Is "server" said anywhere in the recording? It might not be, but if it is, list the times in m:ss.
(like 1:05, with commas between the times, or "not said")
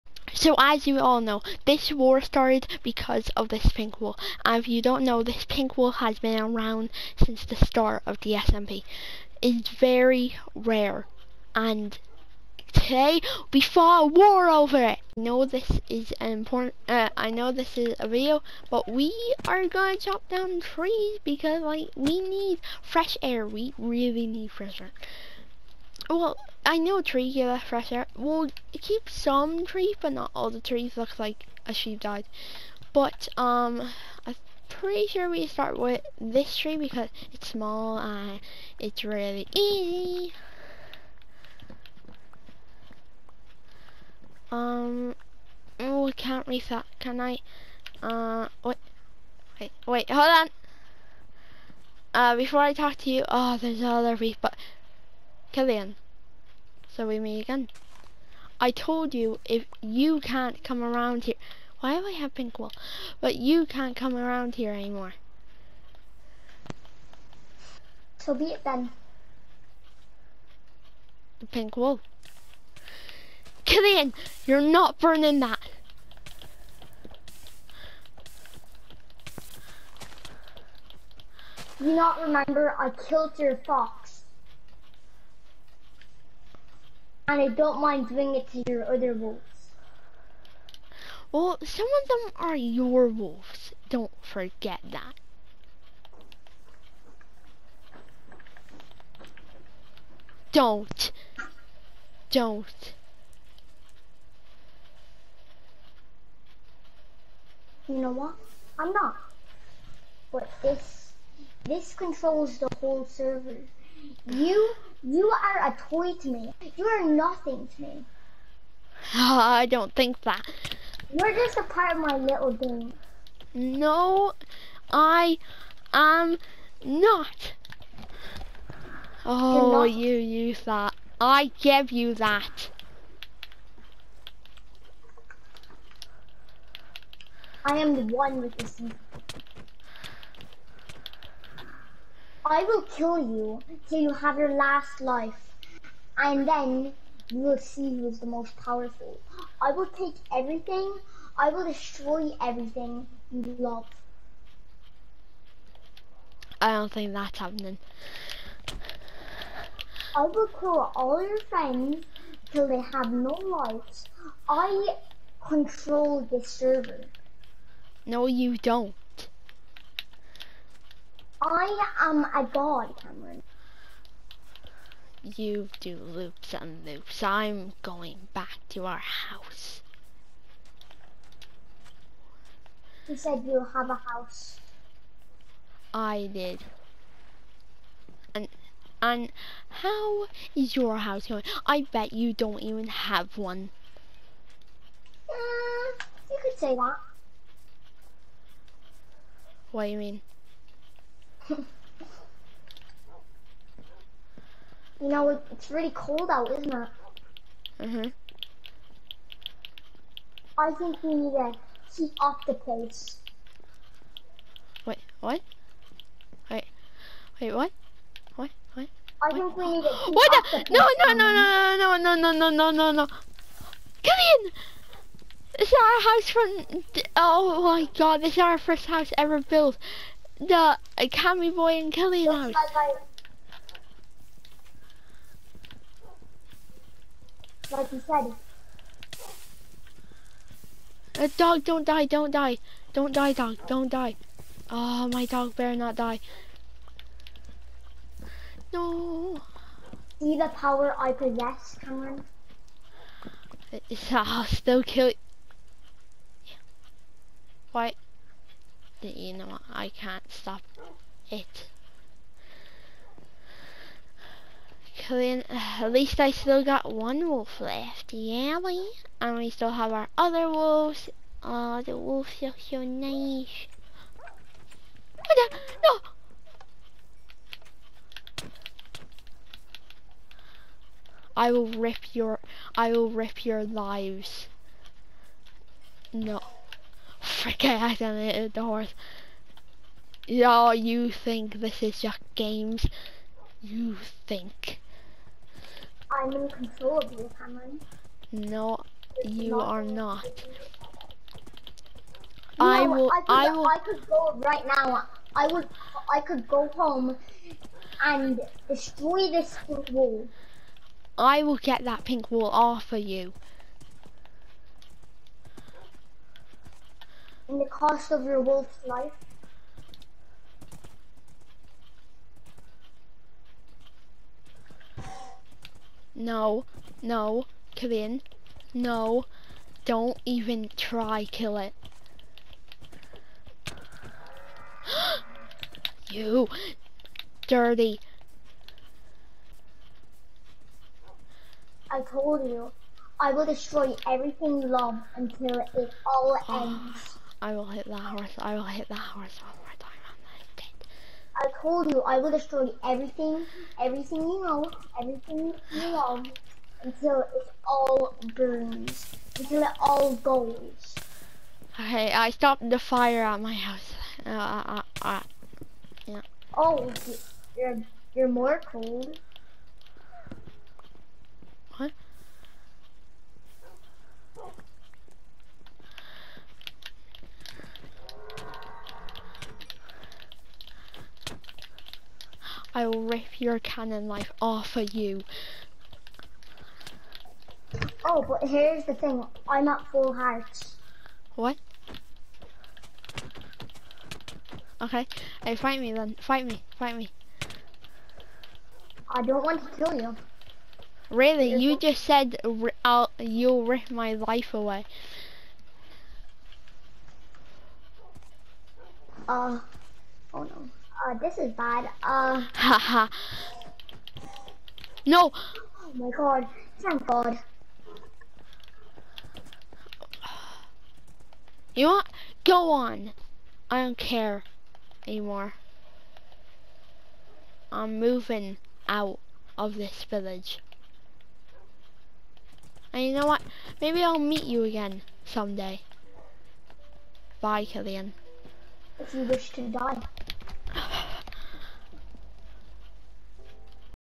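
1:53, 2:46.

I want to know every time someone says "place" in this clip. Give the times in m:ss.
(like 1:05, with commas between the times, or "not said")
3:32, 3:40.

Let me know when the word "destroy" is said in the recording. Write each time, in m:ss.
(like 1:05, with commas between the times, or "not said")
2:31, 5:08, 5:43, 5:52.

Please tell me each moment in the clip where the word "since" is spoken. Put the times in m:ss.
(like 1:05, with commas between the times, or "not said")
0:07.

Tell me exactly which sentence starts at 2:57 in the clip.
I'm going back to our house.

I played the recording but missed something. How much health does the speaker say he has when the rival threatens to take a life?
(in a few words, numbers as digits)
Full hearts.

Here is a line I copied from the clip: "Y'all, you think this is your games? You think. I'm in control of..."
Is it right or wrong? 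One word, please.
right.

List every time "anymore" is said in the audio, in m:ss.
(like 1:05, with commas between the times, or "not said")
1:04, 7:05.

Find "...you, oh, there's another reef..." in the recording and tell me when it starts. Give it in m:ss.
0:53.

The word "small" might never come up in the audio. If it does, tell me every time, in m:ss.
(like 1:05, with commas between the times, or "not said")
0:37.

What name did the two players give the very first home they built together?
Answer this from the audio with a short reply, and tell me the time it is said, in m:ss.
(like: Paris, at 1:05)
Camry boy and Kelly house, at 3:50.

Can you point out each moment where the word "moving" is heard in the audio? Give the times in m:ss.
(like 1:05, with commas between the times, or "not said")
7:07.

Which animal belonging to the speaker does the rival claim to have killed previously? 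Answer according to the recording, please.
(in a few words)
Fox.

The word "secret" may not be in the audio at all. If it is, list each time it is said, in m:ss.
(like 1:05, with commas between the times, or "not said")
2:18.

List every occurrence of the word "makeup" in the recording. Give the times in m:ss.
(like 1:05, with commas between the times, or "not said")
not said.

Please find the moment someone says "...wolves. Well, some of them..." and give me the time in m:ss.
1:29.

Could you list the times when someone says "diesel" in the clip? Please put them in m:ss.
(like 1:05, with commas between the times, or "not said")
not said.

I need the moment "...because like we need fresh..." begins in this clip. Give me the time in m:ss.
0:21.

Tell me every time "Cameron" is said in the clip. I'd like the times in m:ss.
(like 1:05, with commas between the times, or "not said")
2:53, 4:11, 4:57.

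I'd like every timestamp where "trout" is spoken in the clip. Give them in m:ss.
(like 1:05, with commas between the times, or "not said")
not said.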